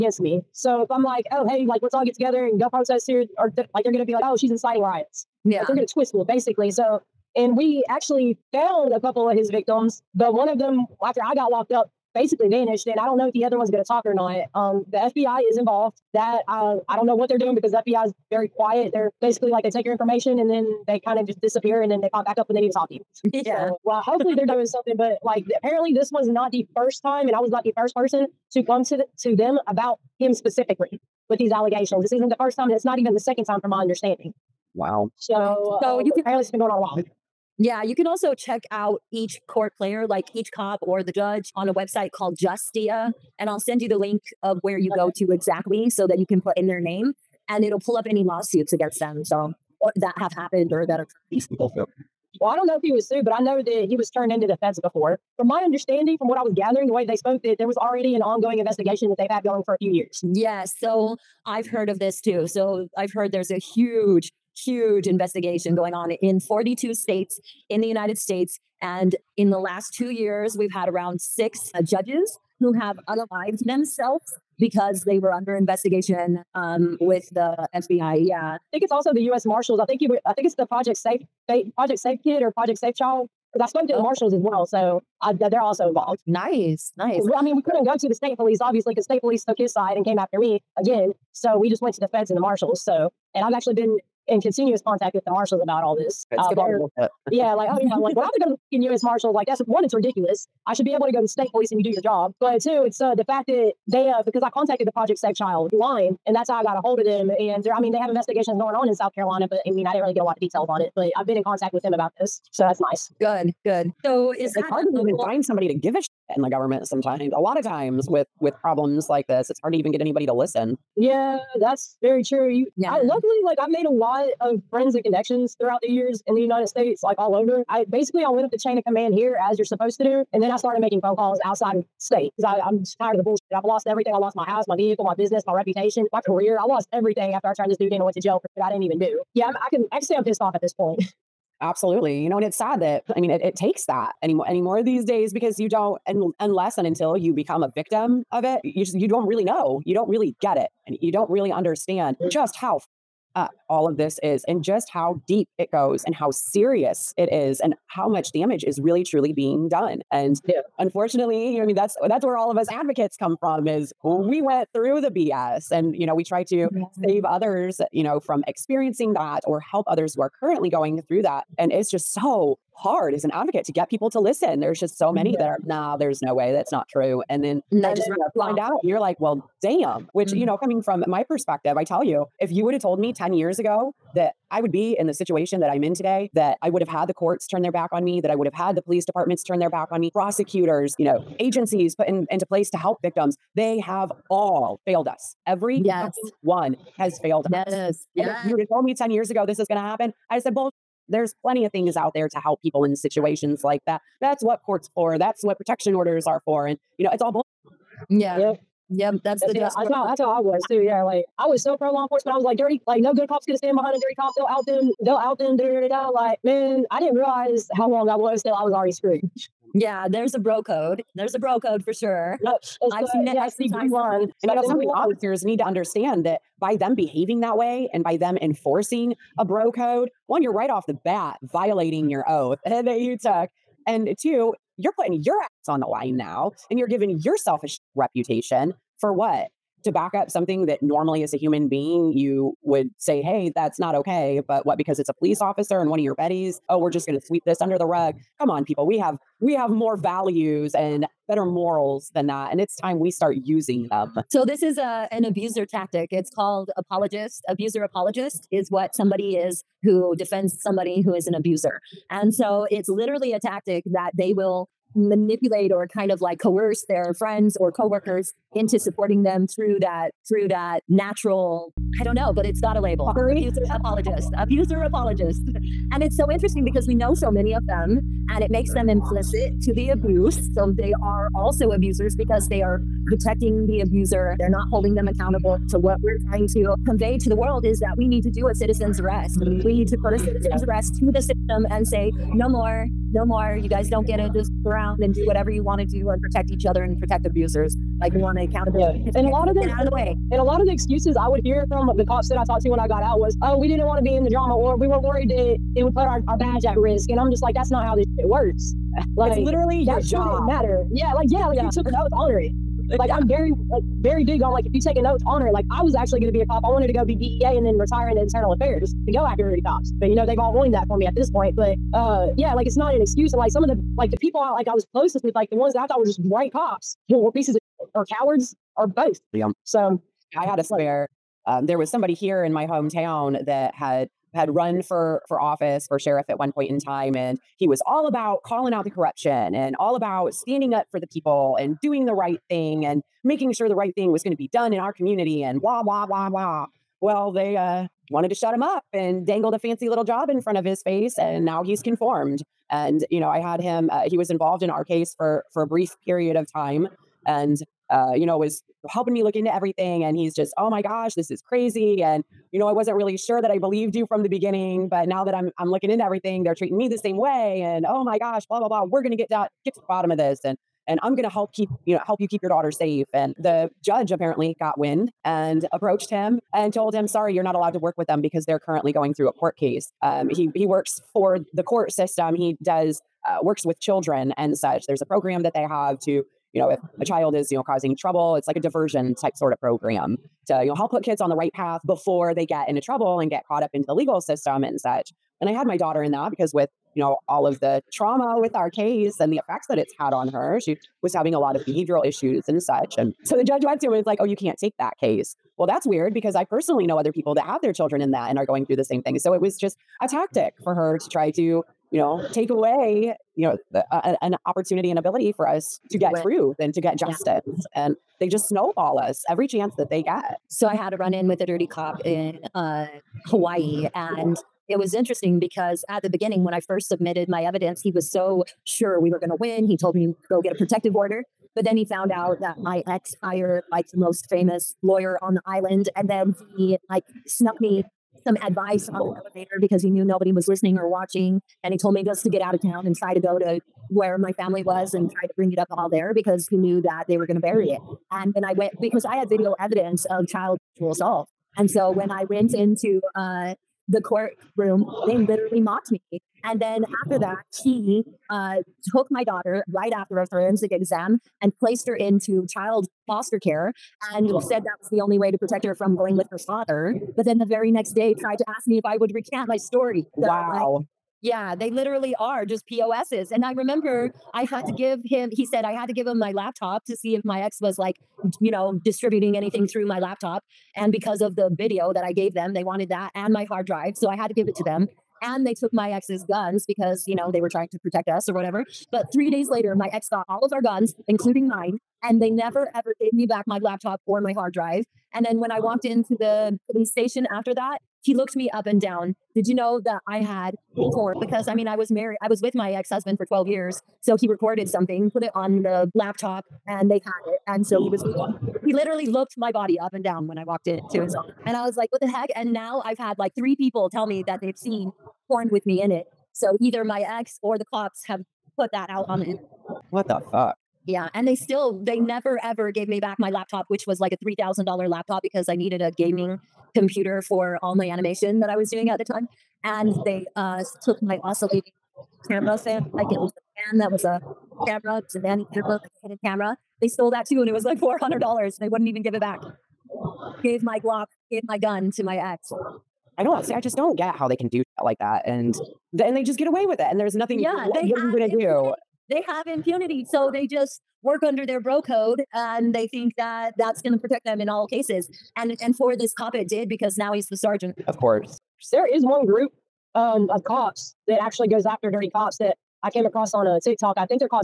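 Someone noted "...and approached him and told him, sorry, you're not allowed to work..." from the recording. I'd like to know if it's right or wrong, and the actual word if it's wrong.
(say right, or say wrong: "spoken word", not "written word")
right.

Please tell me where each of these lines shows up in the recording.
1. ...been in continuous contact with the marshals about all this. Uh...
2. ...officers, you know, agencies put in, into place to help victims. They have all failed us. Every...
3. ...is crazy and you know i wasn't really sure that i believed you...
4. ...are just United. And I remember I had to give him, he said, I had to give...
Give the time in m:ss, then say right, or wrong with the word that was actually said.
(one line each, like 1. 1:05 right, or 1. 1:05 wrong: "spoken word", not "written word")
1. 1:33 right
2. 3:10 wrong: "prosecutors", not "officers"
3. 6:01 right
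4. 7:52 wrong: "POSs", not "United".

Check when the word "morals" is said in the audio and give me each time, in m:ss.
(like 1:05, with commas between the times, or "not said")
4:11.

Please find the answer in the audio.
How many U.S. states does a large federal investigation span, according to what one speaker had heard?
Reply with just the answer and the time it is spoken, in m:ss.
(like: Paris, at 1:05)
42, at 1:06.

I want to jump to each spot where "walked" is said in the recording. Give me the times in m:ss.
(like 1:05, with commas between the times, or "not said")
8:15, 8:30.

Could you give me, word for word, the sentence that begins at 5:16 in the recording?
I wanted to go be DEA and then retire into internal affairs to go after cops.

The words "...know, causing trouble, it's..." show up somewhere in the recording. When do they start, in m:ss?
6:27.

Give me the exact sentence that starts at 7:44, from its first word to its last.
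said that was the only way to protect her from going with her father.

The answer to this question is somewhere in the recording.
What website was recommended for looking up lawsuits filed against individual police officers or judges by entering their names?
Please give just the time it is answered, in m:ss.
0:42.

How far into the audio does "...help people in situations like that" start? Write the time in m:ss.
3:22.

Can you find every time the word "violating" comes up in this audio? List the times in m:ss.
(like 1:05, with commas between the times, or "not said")
3:51.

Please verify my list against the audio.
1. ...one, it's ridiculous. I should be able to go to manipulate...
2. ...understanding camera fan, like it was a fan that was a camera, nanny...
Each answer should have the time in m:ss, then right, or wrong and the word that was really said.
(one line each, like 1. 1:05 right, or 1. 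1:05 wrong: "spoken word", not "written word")
1. 1:39 wrong: "state", not "manipulate"
2. 8:51 wrong: "oscillating", not "understanding".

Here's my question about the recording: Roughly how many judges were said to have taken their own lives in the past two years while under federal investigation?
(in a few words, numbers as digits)
6.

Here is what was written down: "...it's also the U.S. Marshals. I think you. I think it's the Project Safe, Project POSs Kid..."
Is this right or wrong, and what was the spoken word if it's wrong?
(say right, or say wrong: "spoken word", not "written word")
wrong: "Safe", not "POSs".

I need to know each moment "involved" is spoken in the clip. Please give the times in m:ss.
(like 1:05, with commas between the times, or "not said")
0:15, 1:25, 5:54.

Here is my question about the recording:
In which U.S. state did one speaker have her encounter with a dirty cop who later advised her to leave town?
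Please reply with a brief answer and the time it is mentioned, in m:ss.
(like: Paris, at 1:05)
Hawaii, at 7:03.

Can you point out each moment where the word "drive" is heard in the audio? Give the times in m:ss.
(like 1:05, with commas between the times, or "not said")
8:03, 8:14.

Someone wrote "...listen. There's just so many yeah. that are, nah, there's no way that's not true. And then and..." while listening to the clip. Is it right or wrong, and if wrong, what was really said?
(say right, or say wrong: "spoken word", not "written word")
right.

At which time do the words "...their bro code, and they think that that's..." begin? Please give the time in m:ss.
9:11.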